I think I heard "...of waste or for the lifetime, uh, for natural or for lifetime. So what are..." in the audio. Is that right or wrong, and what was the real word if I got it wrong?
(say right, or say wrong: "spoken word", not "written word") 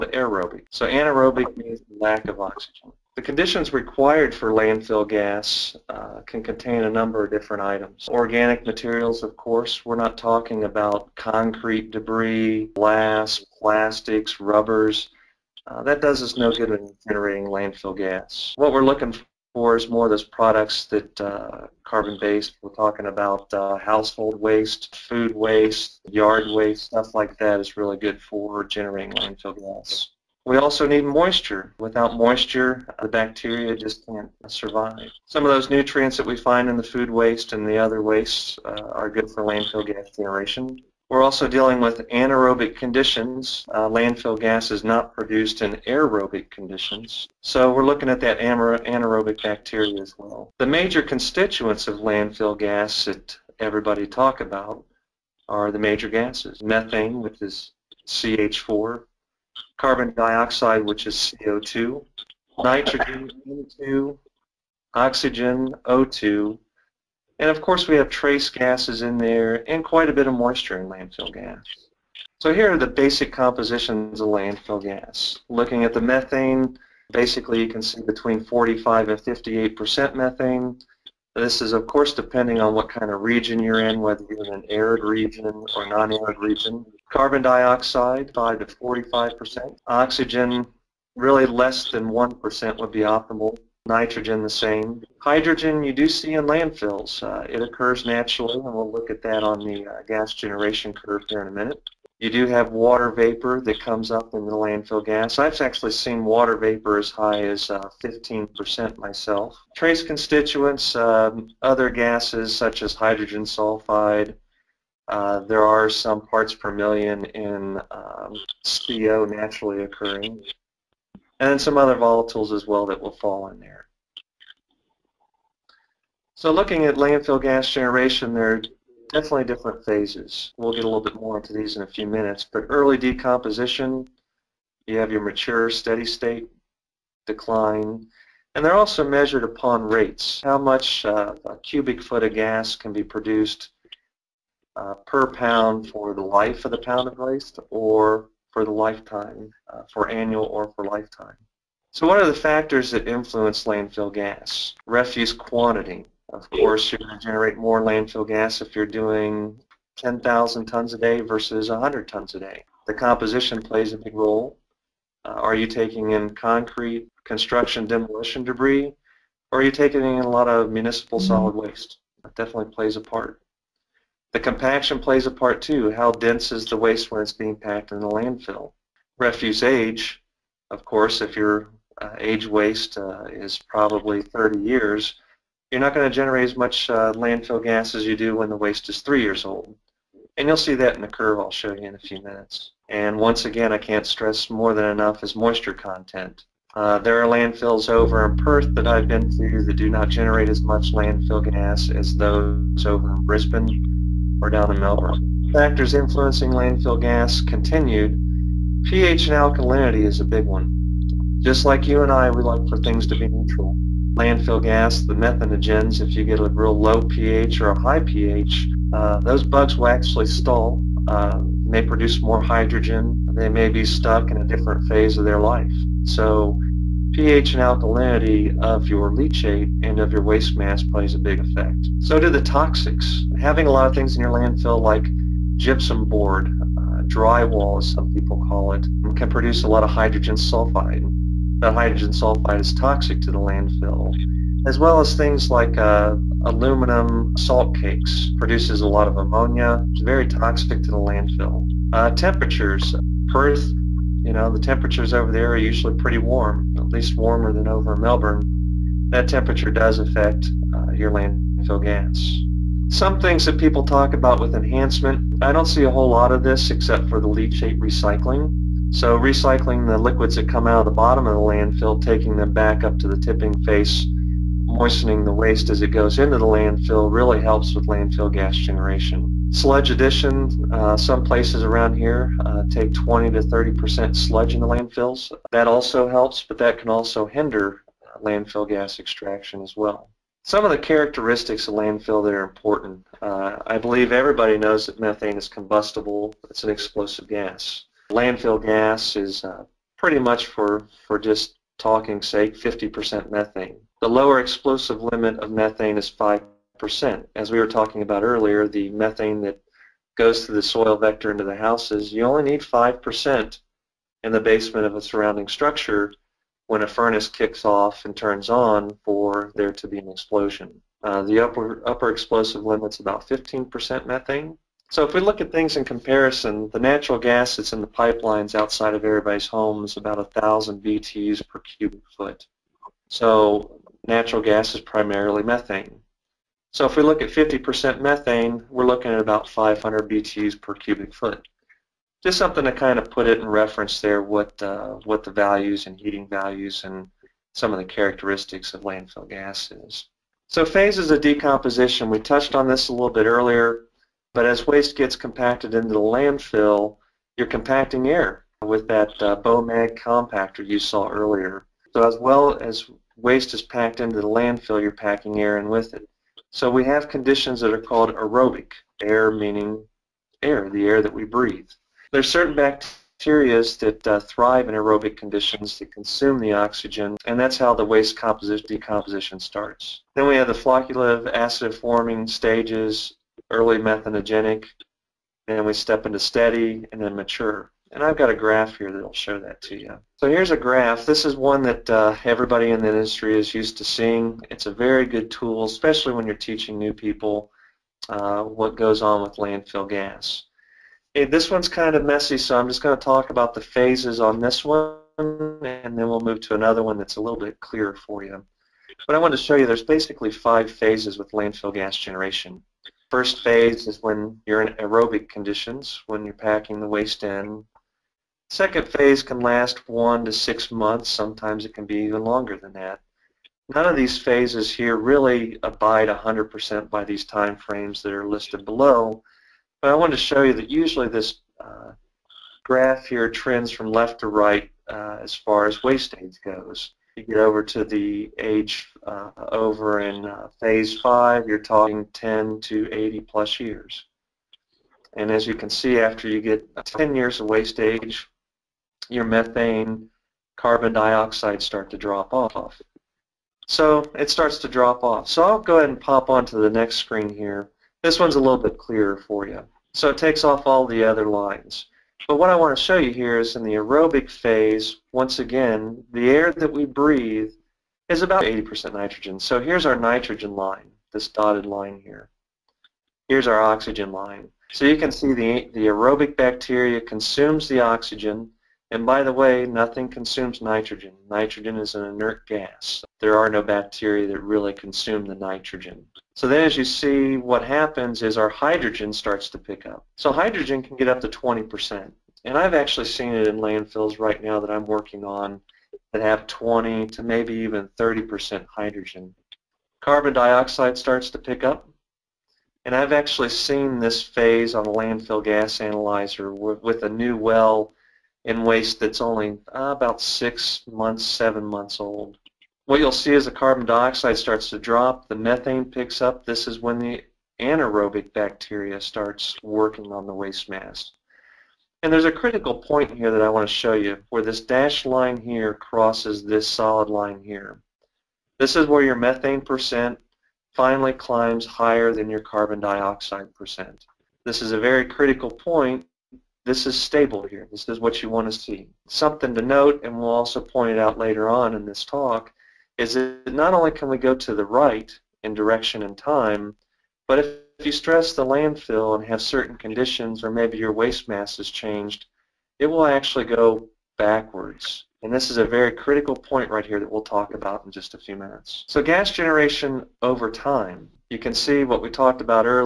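wrong: "annual", not "natural".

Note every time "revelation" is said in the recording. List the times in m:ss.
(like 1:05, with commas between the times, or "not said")
not said.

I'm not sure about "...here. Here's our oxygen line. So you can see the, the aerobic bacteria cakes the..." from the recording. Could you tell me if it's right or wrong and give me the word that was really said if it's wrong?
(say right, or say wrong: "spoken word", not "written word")
wrong: "consumes", not "cakes".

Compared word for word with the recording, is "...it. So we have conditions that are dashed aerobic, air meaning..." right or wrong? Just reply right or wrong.
wrong.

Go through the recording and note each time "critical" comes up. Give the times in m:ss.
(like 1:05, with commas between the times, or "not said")
8:42, 8:55, 9:15.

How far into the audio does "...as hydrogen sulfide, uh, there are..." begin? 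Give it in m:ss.
1:52.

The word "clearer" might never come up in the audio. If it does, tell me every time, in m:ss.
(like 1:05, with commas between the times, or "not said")
6:47, 7:38.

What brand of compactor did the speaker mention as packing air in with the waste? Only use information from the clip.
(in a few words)
BOMAG.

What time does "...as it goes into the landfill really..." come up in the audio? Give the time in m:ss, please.
4:35.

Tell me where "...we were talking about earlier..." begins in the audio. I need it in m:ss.
5:07.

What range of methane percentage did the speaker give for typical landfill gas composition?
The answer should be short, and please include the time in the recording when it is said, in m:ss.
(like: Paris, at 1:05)
45 to 58%, at 1:18.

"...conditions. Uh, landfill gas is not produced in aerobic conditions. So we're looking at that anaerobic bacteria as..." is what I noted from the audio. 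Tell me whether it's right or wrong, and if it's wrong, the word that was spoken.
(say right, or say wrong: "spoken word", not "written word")
right.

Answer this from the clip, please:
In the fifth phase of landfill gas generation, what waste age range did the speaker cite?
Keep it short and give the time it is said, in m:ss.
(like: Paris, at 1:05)
10 to 80 plus years, at 7:22.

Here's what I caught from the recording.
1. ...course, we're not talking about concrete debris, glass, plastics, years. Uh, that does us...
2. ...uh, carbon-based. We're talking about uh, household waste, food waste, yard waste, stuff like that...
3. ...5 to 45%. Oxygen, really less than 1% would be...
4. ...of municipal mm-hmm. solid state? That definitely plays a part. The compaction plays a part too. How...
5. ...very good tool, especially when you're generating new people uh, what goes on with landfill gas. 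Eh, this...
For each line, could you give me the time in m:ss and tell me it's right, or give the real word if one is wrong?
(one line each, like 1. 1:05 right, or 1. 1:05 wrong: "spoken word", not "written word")
1. 0:09 wrong: "rubbers", not "years"
2. 0:21 right
3. 1:28 right
4. 2:50 wrong: "waste", not "state"
5. 6:34 wrong: "teaching", not "generating".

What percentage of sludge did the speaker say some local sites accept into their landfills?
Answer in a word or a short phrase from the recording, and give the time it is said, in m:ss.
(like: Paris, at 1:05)
20 to 30 percent, at 4:42.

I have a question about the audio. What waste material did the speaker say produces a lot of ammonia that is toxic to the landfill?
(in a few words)
aluminum salt cakes.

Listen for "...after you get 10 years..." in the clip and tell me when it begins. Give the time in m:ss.
7:25.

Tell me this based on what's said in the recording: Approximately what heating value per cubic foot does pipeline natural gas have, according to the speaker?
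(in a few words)
1,000 BTUs.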